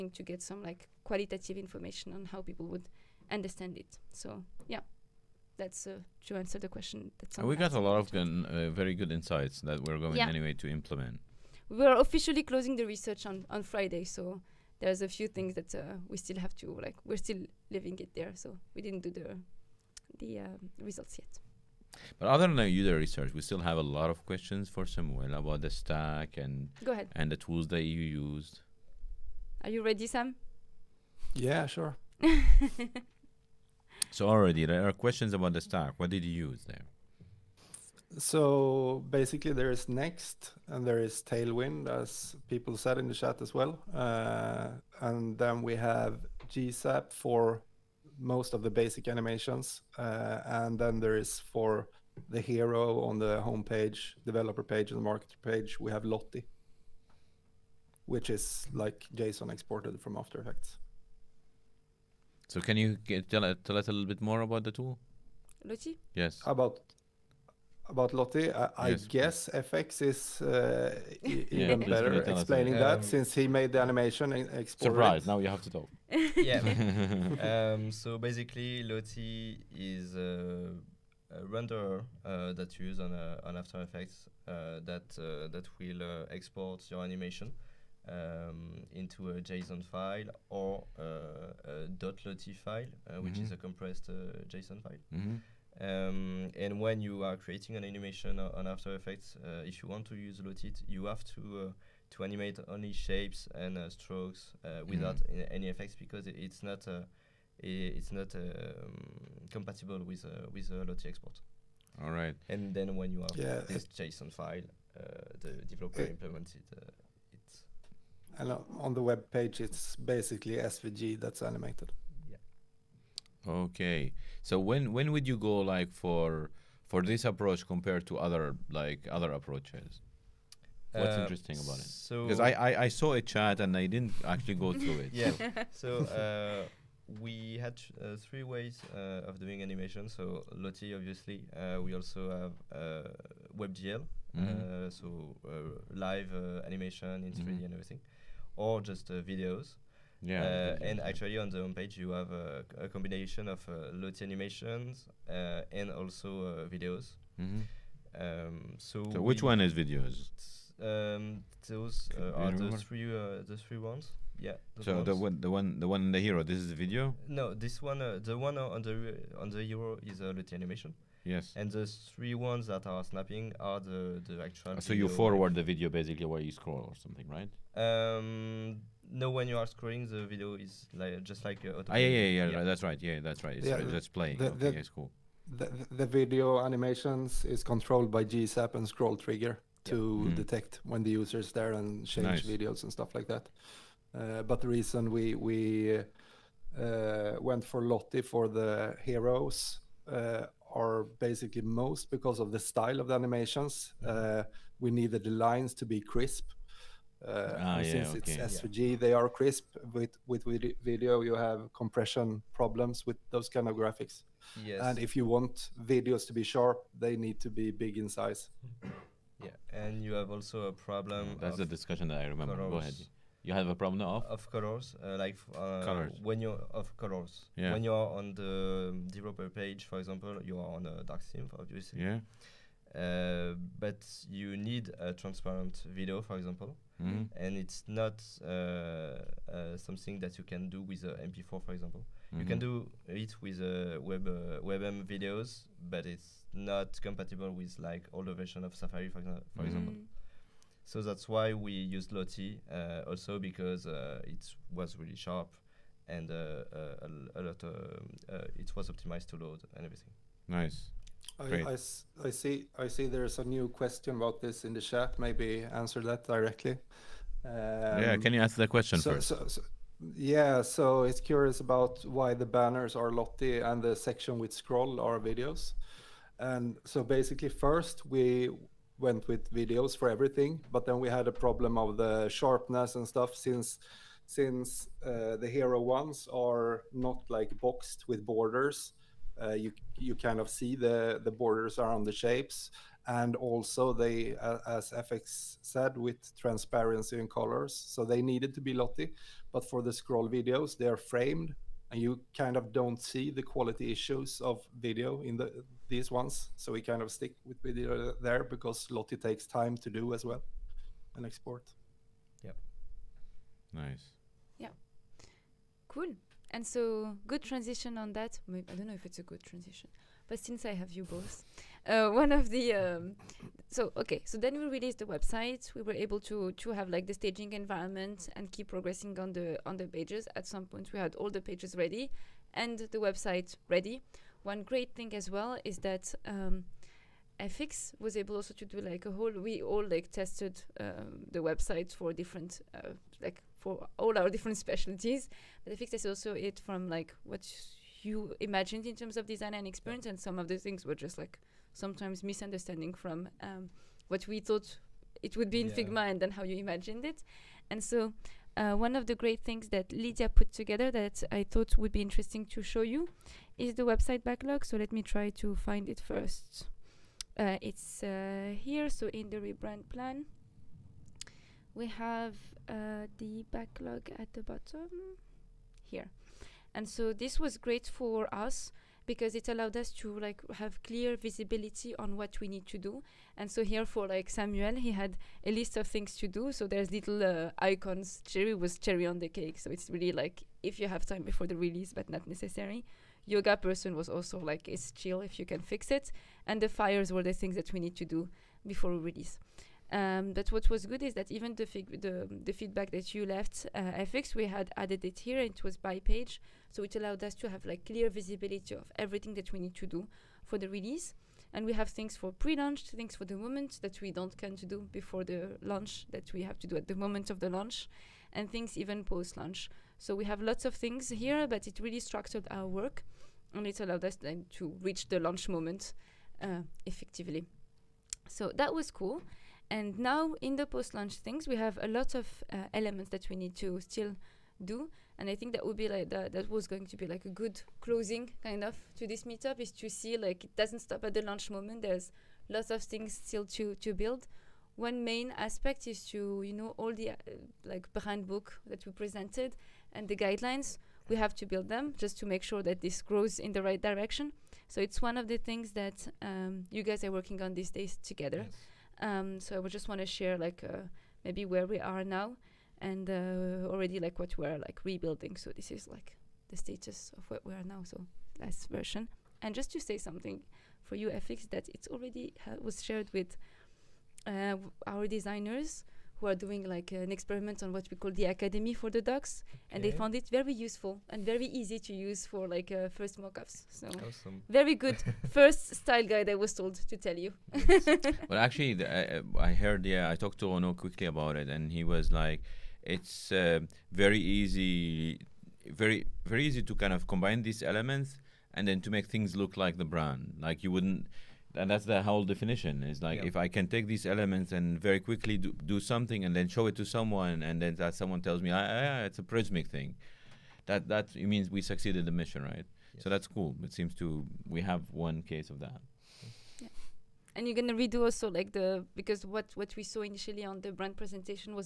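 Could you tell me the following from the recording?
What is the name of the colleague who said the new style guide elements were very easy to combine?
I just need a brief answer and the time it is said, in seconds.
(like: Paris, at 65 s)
Ono, at 490 s.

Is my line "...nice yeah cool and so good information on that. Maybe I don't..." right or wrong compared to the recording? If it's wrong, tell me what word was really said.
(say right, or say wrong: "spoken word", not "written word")
wrong: "transition", not "information".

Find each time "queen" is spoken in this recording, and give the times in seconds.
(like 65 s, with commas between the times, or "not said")
not said.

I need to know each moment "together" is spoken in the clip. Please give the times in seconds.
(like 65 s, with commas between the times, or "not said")
360 s, 458 s.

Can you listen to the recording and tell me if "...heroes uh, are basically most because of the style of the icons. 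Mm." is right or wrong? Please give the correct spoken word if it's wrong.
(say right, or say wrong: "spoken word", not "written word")
wrong: "animations", not "icons".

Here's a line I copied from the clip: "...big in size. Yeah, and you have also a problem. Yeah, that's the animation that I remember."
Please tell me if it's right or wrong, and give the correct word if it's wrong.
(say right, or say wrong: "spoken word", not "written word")
wrong: "discussion", not "animation".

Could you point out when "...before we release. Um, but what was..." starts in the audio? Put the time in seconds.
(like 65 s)
398 s.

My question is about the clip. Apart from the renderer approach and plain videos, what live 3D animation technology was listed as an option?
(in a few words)
WebGL.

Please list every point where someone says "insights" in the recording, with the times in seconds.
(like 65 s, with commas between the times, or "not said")
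9 s.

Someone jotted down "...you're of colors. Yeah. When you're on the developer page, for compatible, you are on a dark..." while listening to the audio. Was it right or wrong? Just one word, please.
wrong.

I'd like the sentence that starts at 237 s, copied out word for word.
and it's not uh, uh, something that you can do with a MP4, for example.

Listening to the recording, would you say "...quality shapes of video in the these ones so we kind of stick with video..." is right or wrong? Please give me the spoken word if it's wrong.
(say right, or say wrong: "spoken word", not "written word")
wrong: "issues", not "shapes".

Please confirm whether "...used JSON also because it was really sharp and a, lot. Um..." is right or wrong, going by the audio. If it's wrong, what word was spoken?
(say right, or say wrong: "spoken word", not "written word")
wrong: "Lottie", not "JSON".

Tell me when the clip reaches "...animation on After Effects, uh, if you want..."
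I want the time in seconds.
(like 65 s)
97 s.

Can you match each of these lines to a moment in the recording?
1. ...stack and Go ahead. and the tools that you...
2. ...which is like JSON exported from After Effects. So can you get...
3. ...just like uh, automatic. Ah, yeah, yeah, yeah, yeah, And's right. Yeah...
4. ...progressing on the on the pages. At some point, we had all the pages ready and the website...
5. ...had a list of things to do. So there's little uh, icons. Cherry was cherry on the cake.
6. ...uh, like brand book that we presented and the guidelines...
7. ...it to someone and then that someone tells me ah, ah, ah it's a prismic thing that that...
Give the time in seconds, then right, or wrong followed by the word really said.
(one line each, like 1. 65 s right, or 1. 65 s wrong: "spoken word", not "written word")
1. 25 s right
2. 58 s right
3. 181 s wrong: "That", not "And"
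4. 328 s right
5. 384 s right
6. 447 s right
7. 506 s right.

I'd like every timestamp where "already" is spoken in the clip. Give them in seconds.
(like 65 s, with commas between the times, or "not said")
34 s, 463 s, 471 s.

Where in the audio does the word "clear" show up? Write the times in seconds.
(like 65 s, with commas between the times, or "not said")
380 s, 407 s.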